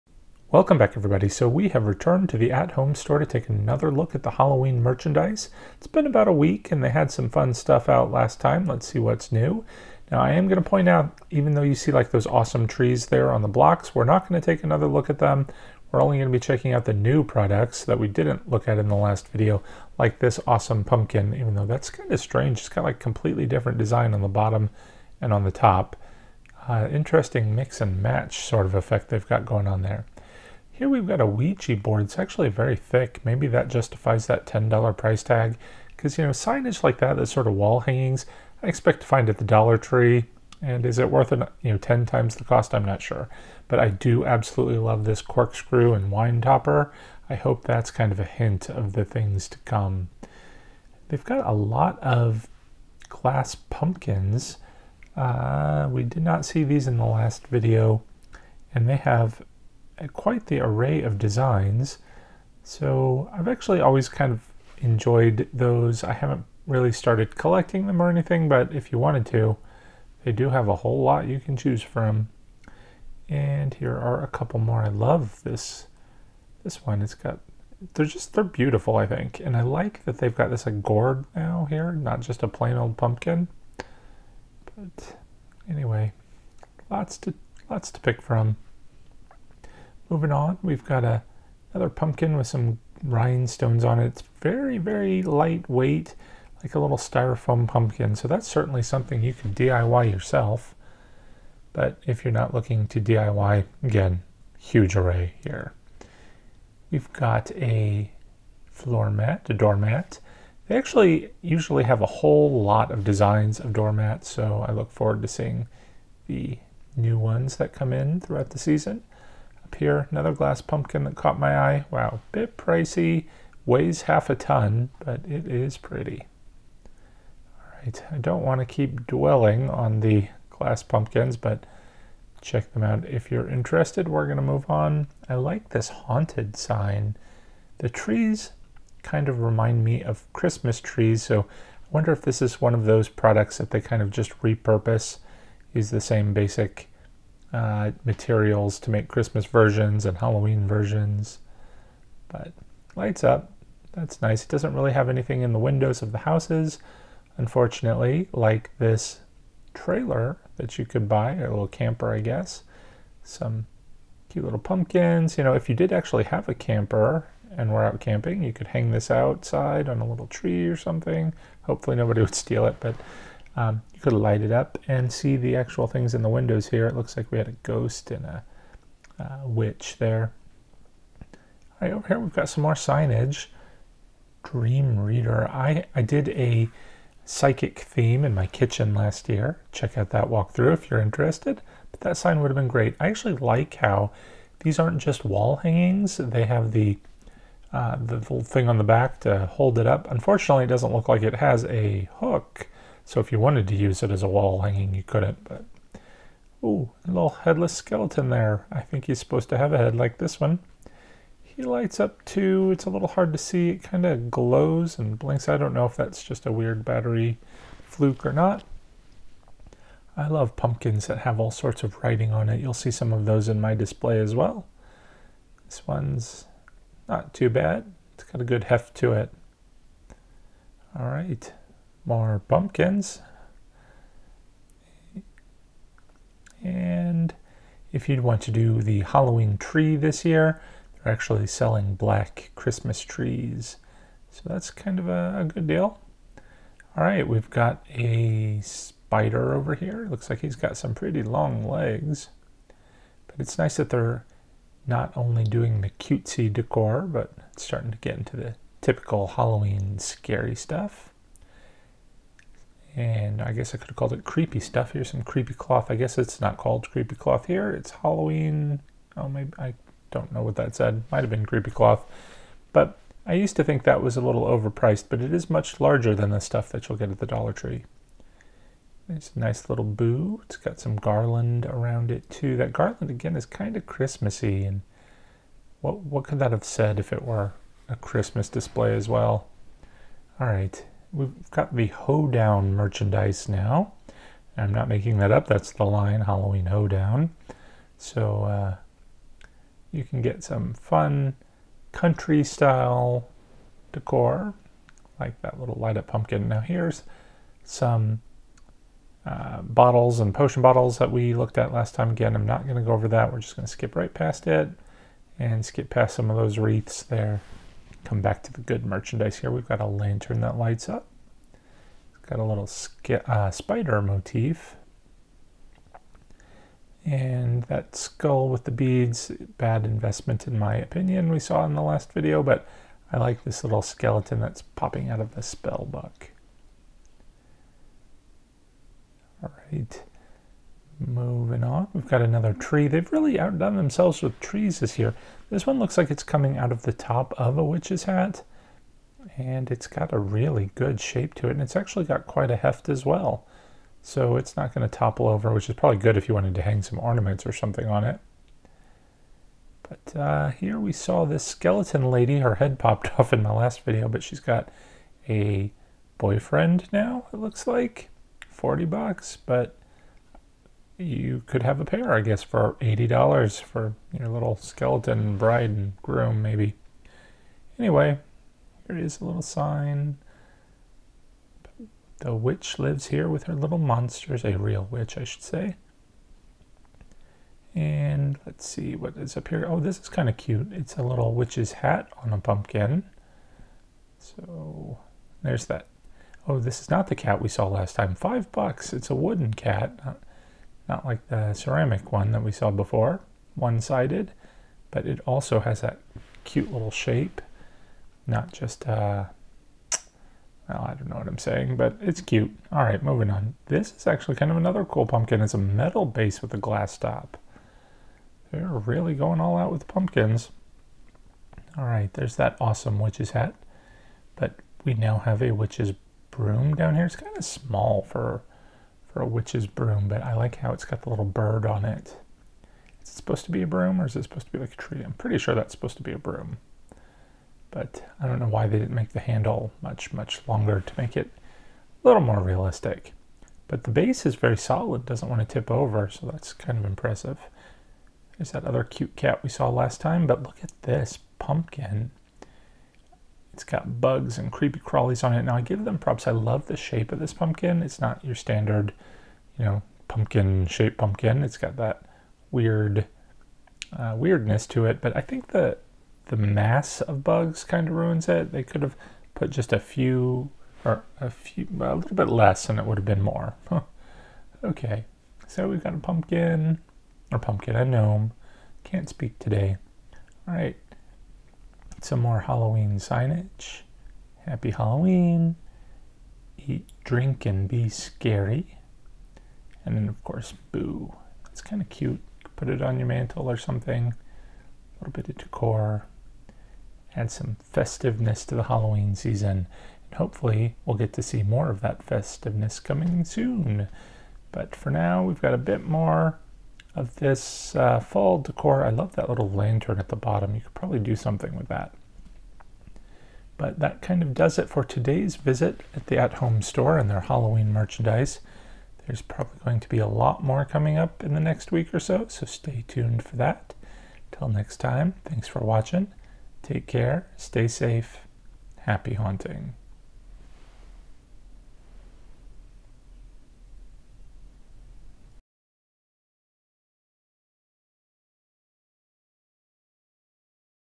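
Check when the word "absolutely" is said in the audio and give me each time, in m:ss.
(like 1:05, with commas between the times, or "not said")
0:44.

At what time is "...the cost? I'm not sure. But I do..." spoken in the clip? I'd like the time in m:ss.
0:42.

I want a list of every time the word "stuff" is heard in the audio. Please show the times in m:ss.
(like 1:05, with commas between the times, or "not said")
0:07, 4:20, 4:24, 4:36.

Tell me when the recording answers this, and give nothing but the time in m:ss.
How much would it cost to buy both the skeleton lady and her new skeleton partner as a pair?
6:12.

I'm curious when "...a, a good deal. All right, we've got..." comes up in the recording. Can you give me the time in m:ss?
4:05.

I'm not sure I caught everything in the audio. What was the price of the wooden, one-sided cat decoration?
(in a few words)
$5.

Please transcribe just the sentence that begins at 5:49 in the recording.
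And it's got a really good shape to it.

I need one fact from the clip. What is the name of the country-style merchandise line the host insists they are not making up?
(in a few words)
Halloween hoedown.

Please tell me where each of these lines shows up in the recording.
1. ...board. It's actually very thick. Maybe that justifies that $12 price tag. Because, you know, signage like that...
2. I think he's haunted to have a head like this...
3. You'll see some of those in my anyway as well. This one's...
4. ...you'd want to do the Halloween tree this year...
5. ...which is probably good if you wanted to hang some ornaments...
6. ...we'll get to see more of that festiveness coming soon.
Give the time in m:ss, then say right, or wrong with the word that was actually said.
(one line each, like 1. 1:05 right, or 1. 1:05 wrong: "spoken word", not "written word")
1. 0:31 wrong: "10", not "12"
2. 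3:28 wrong: "supposed", not "haunted"
3. 3:42 wrong: "display", not "anyway"
4. 3:58 right
5. 5:55 right
6. 8:20 right.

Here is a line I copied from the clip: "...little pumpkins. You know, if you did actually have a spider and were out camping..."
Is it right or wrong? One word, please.
wrong.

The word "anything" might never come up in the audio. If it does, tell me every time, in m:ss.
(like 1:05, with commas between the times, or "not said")
1:08, 2:35.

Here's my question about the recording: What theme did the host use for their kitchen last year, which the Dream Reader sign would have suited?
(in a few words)
Psychic theme.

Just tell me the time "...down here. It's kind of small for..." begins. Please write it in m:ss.
7:06.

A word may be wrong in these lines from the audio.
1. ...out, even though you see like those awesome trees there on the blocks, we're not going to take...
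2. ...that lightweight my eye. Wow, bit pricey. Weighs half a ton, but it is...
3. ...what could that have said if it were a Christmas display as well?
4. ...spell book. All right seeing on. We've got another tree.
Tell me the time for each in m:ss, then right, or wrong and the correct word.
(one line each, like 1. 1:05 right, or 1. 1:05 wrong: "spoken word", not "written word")
1. 0:10 right
2. 2:01 wrong: "caught", not "lightweight"
3. 4:46 right
4. 5:35 wrong: "moving", not "seeing".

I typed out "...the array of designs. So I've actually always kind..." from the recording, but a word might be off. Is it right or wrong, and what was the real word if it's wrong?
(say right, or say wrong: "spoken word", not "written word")
right.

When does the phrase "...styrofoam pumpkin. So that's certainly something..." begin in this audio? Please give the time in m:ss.
1:36.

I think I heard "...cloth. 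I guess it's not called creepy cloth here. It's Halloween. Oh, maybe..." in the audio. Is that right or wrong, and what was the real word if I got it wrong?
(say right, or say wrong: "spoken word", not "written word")
right.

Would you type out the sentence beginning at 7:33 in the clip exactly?
It's got bugs and creepy crawlies on it.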